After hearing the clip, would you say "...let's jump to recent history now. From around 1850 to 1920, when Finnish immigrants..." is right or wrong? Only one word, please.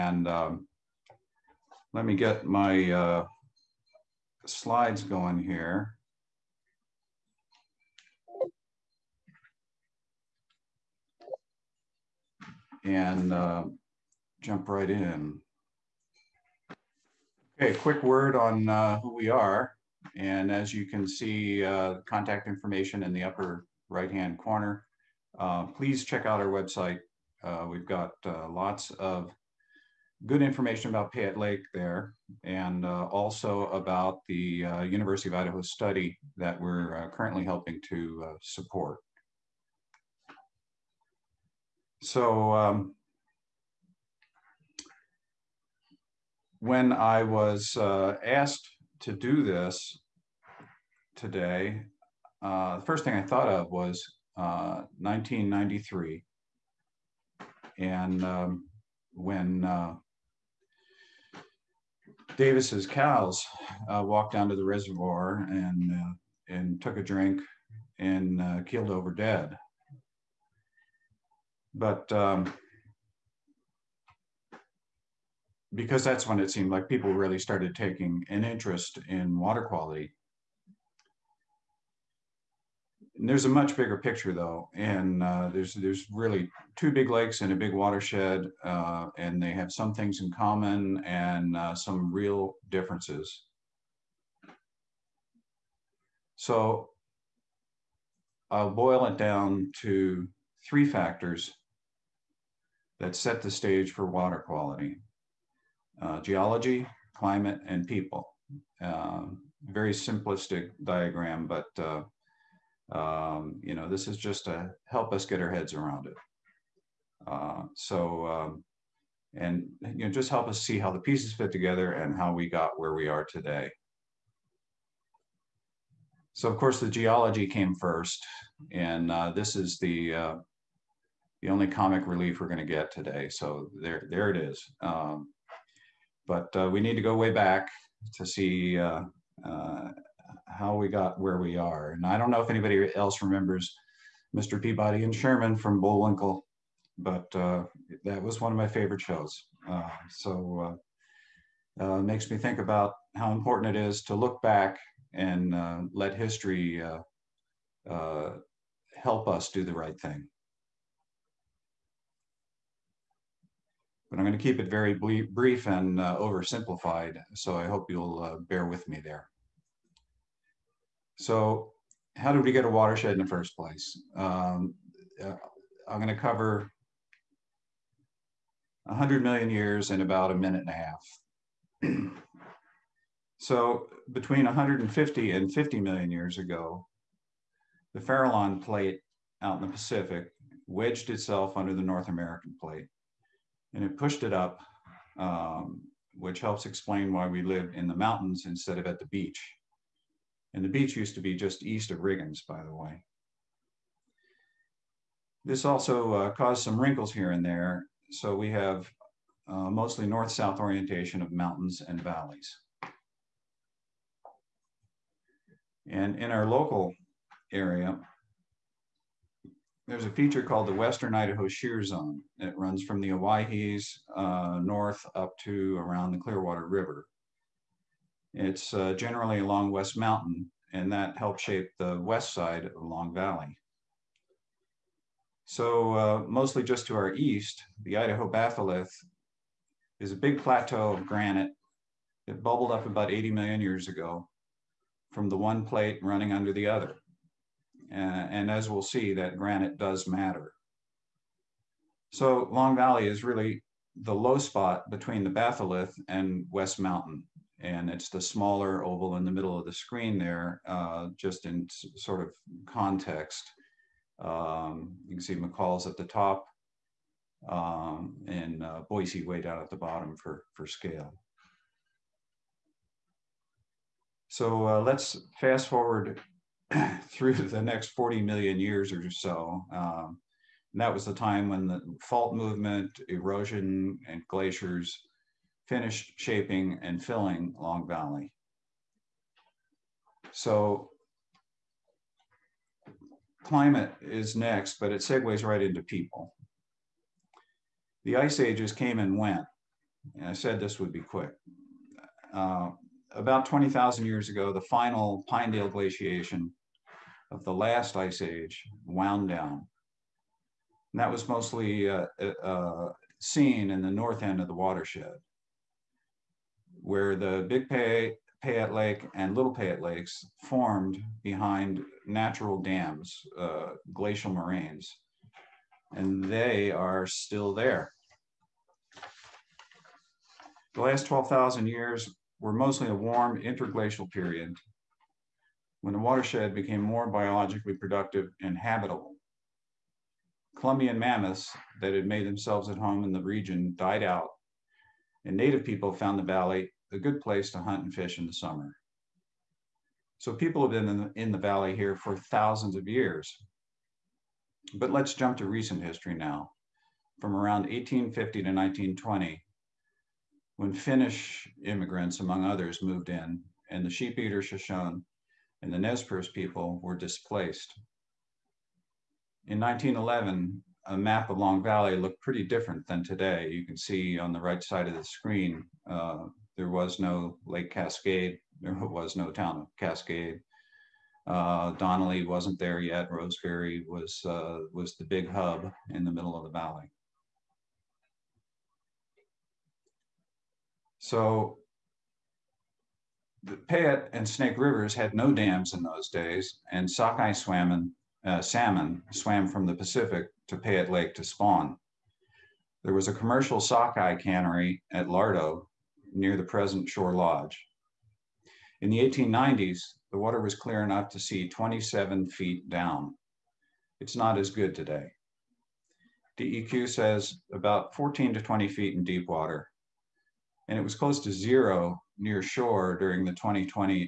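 right.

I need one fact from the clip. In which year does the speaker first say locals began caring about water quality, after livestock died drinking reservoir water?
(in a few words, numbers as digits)
1993.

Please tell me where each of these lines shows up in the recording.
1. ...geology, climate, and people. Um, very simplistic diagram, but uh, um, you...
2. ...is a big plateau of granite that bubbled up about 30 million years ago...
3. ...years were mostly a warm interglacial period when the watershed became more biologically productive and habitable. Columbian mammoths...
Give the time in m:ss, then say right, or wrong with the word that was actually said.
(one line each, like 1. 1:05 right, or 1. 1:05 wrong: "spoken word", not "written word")
1. 1:46 right
2. 4:00 wrong: "80", not "30"
3. 5:31 right.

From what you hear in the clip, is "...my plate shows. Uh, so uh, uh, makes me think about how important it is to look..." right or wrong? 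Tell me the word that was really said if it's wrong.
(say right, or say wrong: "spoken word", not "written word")
wrong: "favorite", not "plate".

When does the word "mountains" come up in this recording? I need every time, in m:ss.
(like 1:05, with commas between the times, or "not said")
3:17, 3:31, 3:49, 4:16.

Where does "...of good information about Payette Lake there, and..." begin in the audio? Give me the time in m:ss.
0:28.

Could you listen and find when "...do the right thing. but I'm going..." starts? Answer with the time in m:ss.
2:39.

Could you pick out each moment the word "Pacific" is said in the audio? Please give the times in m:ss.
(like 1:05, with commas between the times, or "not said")
3:09, 6:39.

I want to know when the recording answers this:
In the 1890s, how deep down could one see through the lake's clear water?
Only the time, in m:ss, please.
6:51.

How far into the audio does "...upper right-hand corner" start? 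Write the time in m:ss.
0:23.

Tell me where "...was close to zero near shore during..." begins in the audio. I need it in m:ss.
7:00.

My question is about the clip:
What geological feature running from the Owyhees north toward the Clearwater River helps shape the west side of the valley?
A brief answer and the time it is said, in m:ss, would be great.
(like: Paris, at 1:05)
Western Idaho Shear Zone, at 3:40.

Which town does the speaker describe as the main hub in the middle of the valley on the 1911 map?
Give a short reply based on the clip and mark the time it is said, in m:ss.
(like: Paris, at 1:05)
Roseberry, at 6:23.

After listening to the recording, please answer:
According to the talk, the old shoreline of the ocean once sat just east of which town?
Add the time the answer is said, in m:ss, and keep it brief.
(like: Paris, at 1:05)
Riggins, at 3:21.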